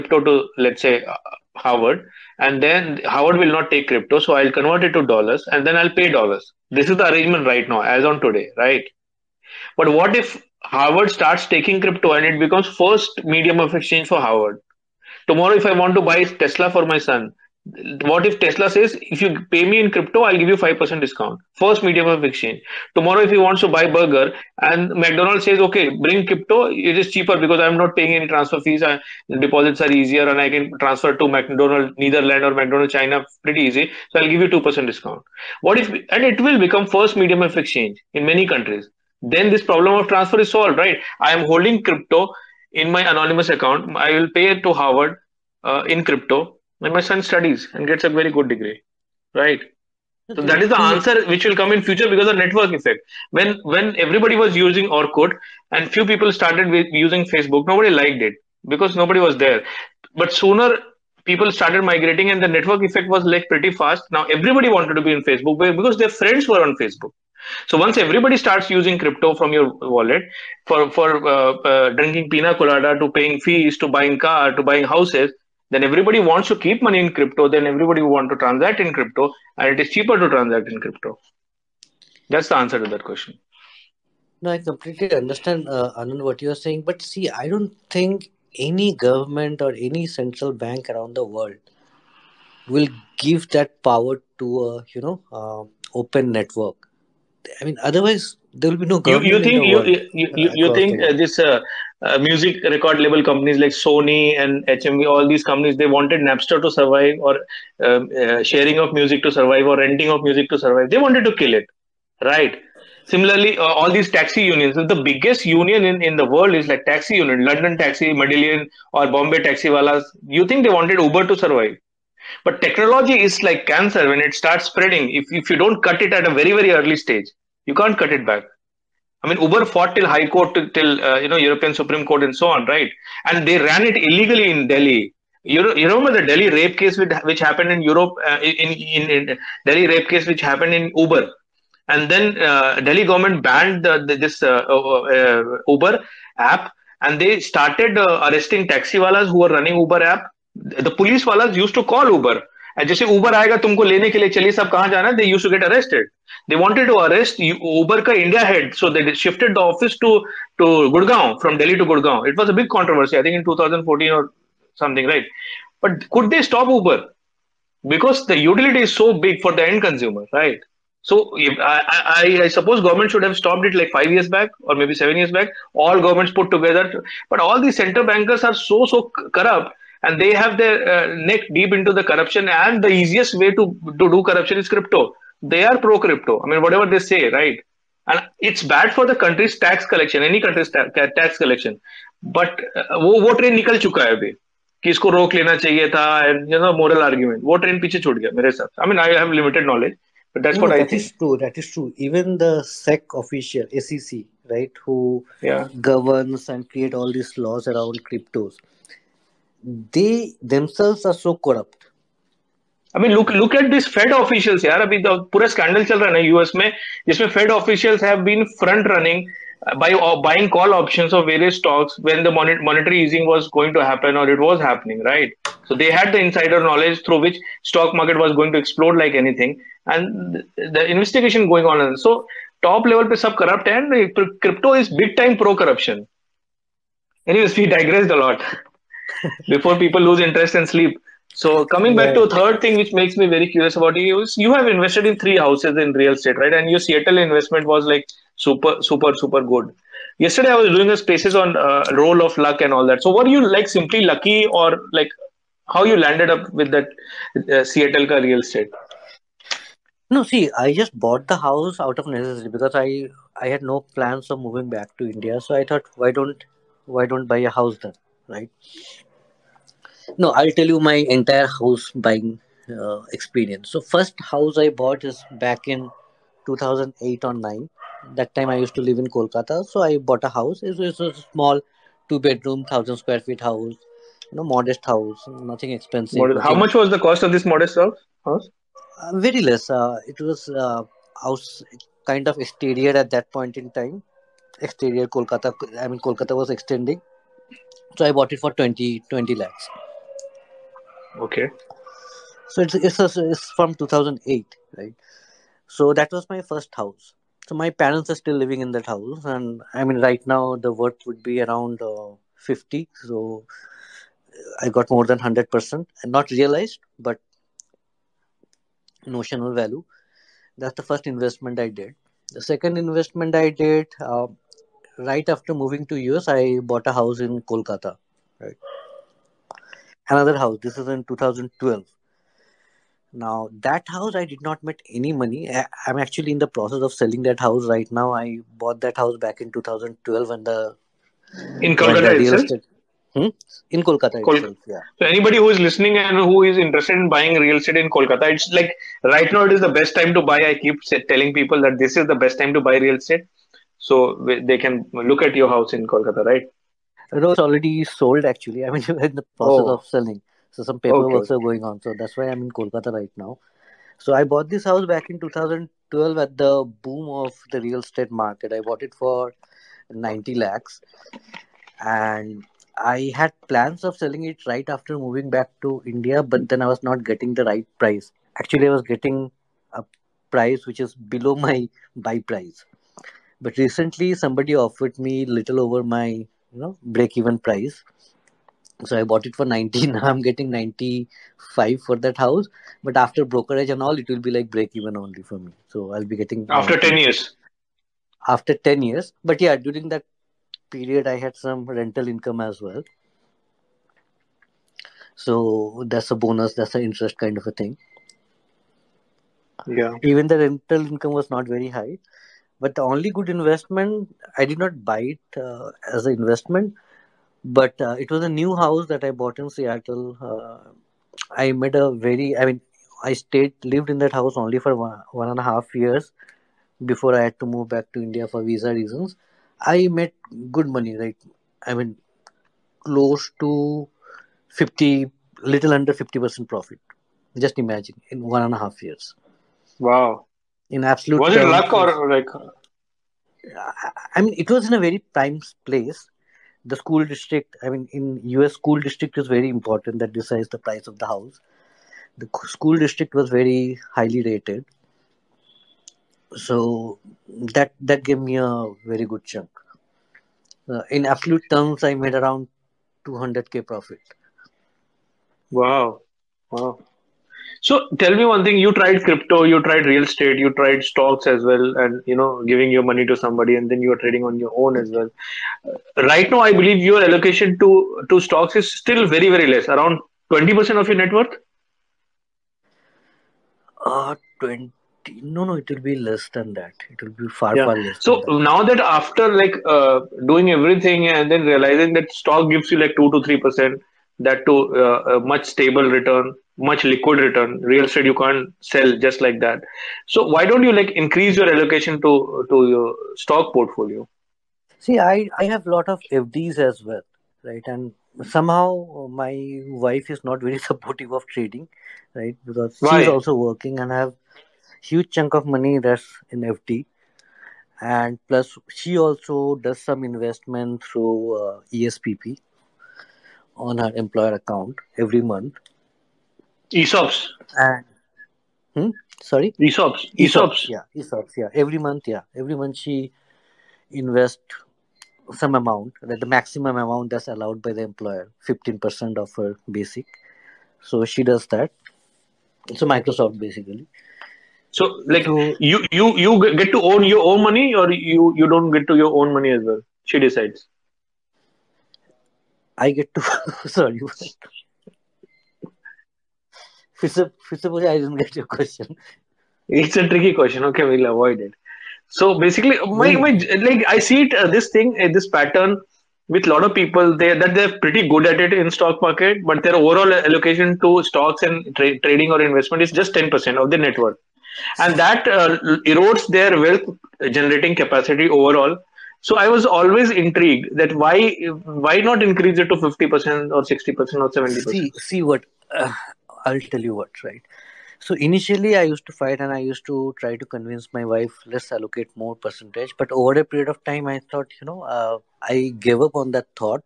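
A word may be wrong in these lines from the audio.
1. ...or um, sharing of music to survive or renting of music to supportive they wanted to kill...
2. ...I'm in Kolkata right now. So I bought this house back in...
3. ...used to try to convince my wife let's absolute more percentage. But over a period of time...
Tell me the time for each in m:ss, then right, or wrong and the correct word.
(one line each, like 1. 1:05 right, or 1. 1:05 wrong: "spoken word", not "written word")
1. 1:47 wrong: "survive", not "supportive"
2. 6:02 right
3. 9:49 wrong: "allocate", not "absolute".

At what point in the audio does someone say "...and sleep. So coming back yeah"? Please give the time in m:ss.
4:00.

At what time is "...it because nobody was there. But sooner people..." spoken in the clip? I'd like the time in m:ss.
0:58.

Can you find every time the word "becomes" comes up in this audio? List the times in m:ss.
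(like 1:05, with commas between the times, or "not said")
0:12, 0:36.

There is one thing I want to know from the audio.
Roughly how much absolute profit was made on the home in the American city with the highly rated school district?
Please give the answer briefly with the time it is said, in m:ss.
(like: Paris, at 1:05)
200k, at 7:43.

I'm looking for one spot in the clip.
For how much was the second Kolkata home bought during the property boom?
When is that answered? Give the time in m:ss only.
6:09.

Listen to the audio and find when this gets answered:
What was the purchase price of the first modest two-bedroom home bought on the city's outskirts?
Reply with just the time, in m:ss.
4:58.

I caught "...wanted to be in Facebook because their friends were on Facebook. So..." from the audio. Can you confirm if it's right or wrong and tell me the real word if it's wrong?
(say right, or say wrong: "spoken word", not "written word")
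right.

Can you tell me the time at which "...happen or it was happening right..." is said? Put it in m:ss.
3:43.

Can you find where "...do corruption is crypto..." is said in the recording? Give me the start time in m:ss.
3:04.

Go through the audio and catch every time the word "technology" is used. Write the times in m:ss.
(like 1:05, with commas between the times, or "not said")
2:02.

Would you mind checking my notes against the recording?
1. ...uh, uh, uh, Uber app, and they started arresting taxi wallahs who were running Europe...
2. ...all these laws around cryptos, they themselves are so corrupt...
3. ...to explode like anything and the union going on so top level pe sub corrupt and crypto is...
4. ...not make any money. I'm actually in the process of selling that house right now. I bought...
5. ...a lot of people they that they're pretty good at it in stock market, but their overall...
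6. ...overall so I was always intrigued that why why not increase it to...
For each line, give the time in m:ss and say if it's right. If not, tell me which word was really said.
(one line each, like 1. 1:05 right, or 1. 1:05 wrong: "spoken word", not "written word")
1. 2:24 wrong: "Uber", not "Europe"
2. 3:26 right
3. 3:48 wrong: "investigation", not "union"
4. 5:34 right
5. 9:26 right
6. 9:38 right.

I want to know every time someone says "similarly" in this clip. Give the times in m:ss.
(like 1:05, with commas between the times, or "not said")
1:53.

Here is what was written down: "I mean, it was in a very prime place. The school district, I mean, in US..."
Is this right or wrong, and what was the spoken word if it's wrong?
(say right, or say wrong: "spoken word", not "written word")
right.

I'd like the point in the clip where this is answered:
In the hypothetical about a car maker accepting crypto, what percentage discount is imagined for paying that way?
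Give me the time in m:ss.
0:20.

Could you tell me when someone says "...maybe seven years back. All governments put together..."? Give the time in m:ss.
2:54.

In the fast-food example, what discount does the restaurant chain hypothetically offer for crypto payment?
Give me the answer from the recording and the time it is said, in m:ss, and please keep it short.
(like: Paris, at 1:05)
2%, at 0:34.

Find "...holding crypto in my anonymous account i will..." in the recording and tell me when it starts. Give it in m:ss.
0:41.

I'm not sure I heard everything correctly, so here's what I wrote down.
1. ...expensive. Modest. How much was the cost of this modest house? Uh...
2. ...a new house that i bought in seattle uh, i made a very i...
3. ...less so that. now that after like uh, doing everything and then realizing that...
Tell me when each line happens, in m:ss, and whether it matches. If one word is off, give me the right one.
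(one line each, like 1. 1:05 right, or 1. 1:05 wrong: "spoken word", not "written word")
1. 4:45 right
2. 6:58 right
3. 8:07 right.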